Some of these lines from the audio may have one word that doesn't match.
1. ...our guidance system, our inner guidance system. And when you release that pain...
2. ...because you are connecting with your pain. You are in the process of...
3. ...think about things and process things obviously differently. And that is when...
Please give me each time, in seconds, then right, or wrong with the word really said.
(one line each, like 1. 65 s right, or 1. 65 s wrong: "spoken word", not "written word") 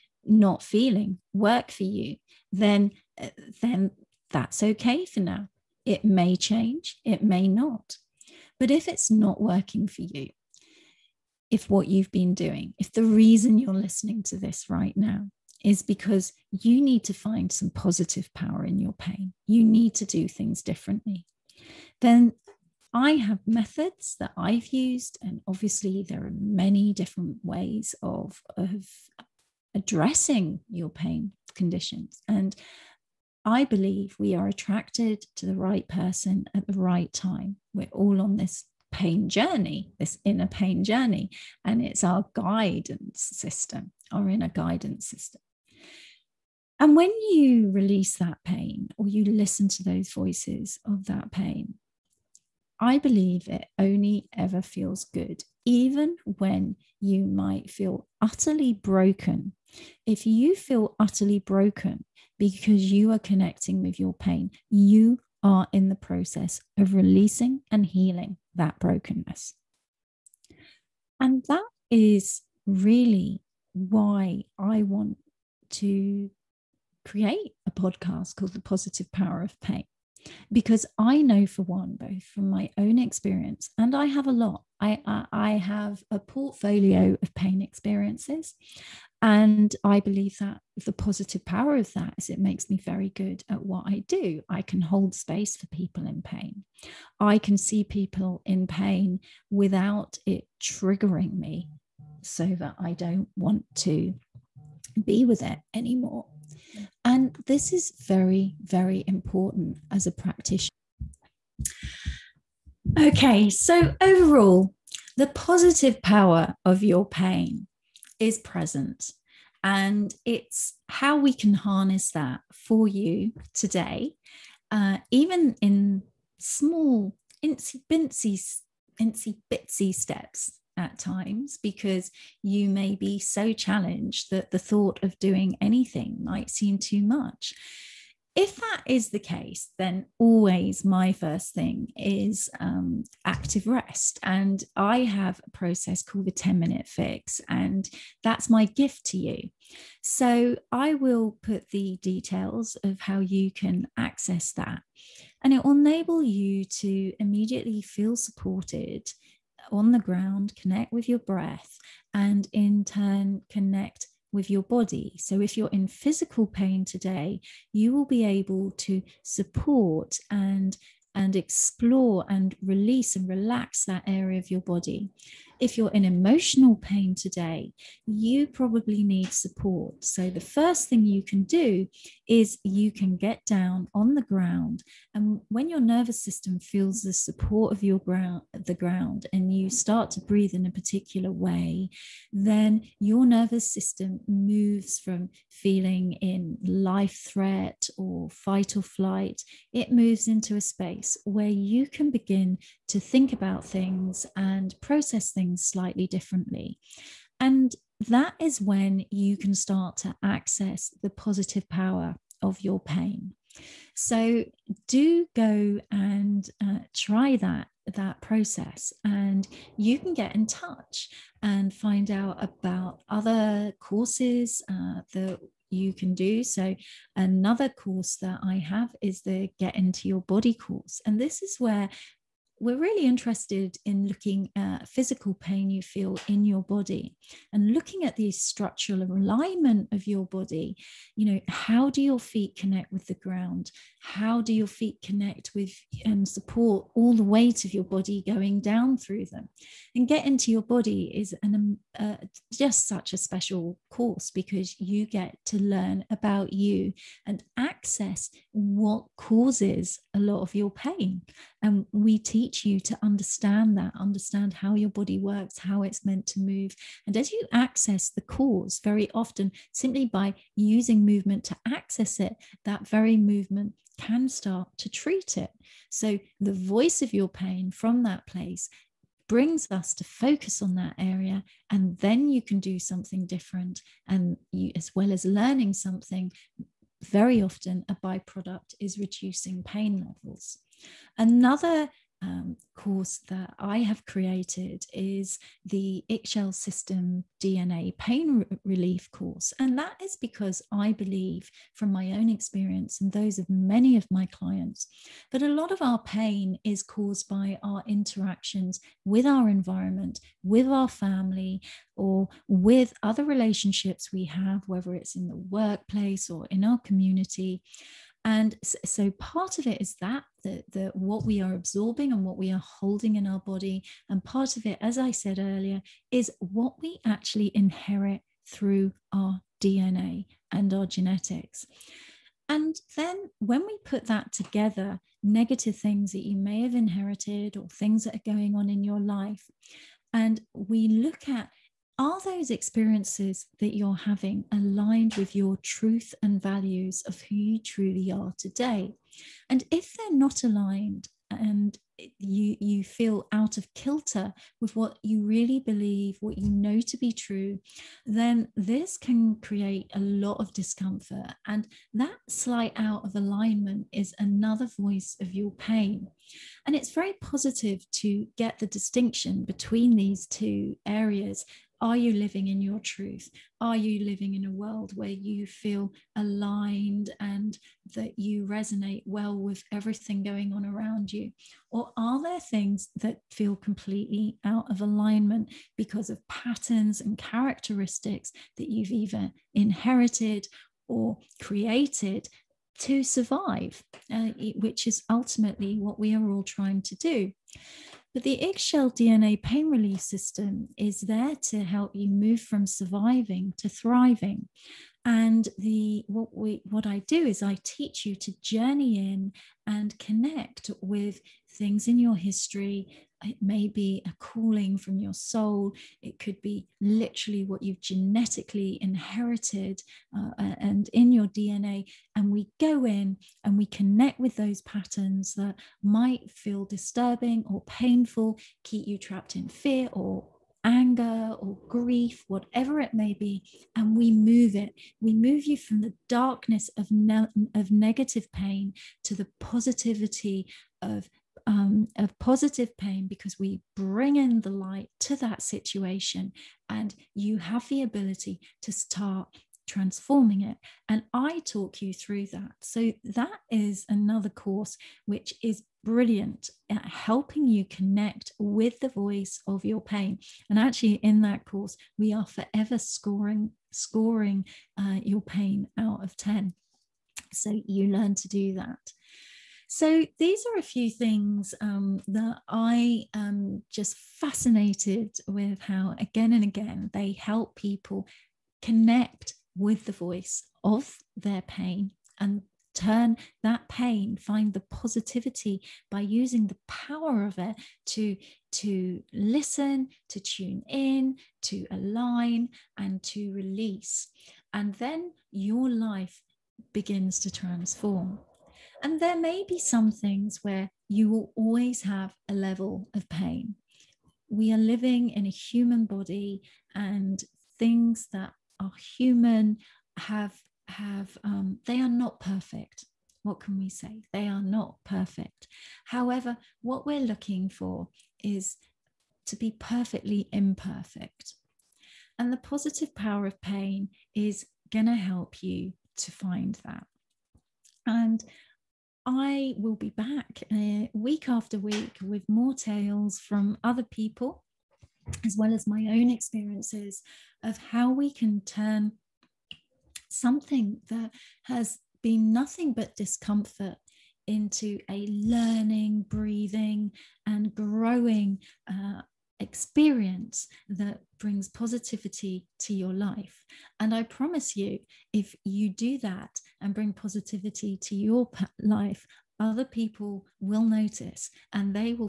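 1. 42 s right
2. 62 s right
3. 202 s wrong: "slightly", not "obviously".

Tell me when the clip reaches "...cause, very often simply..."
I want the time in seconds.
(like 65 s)
268 s.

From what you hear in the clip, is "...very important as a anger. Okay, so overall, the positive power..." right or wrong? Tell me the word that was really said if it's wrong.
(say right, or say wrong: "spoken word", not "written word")
wrong: "practitioner", not "anger".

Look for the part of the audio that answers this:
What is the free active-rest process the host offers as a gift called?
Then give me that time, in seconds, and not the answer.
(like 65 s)
146 s.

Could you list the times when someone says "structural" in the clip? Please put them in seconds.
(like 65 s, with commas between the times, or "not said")
238 s.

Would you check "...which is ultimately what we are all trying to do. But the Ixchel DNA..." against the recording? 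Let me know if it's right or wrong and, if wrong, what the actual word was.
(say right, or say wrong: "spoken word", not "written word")
right.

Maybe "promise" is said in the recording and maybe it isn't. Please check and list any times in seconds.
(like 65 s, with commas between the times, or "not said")
554 s.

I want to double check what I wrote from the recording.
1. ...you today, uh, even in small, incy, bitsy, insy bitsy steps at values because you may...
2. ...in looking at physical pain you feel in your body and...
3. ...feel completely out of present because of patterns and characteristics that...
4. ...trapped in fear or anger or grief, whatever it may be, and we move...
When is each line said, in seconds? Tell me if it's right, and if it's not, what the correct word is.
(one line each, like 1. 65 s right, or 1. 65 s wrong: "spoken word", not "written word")
1. 122 s wrong: "times", not "values"
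2. 233 s right
3. 383 s wrong: "alignment", not "present"
4. 428 s right.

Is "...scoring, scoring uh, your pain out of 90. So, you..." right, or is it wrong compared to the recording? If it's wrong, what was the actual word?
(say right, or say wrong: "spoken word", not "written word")
wrong: "10", not "90".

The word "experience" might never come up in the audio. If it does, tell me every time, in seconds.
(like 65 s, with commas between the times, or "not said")
82 s, 87 s, 302 s, 342 s, 536 s, 549 s.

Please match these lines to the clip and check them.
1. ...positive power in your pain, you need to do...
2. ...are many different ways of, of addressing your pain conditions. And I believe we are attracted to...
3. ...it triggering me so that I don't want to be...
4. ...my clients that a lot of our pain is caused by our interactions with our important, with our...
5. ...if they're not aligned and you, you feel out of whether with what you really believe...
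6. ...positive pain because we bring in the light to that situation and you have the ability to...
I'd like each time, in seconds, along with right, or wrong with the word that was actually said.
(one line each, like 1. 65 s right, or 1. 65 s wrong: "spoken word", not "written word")
1. 17 s right
2. 26 s right
3. 100 s right
4. 304 s wrong: "environment", not "important"
5. 349 s wrong: "kilter", not "whether"
6. 442 s right.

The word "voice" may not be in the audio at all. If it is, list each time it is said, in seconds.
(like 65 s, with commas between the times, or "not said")
50 s, 276 s, 364 s, 458 s, 479 s.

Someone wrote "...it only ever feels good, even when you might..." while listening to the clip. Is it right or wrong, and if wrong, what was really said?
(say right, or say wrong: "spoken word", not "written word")
right.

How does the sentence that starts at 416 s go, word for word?
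It could be literally what you've genetically inherited uh, and in your DNA.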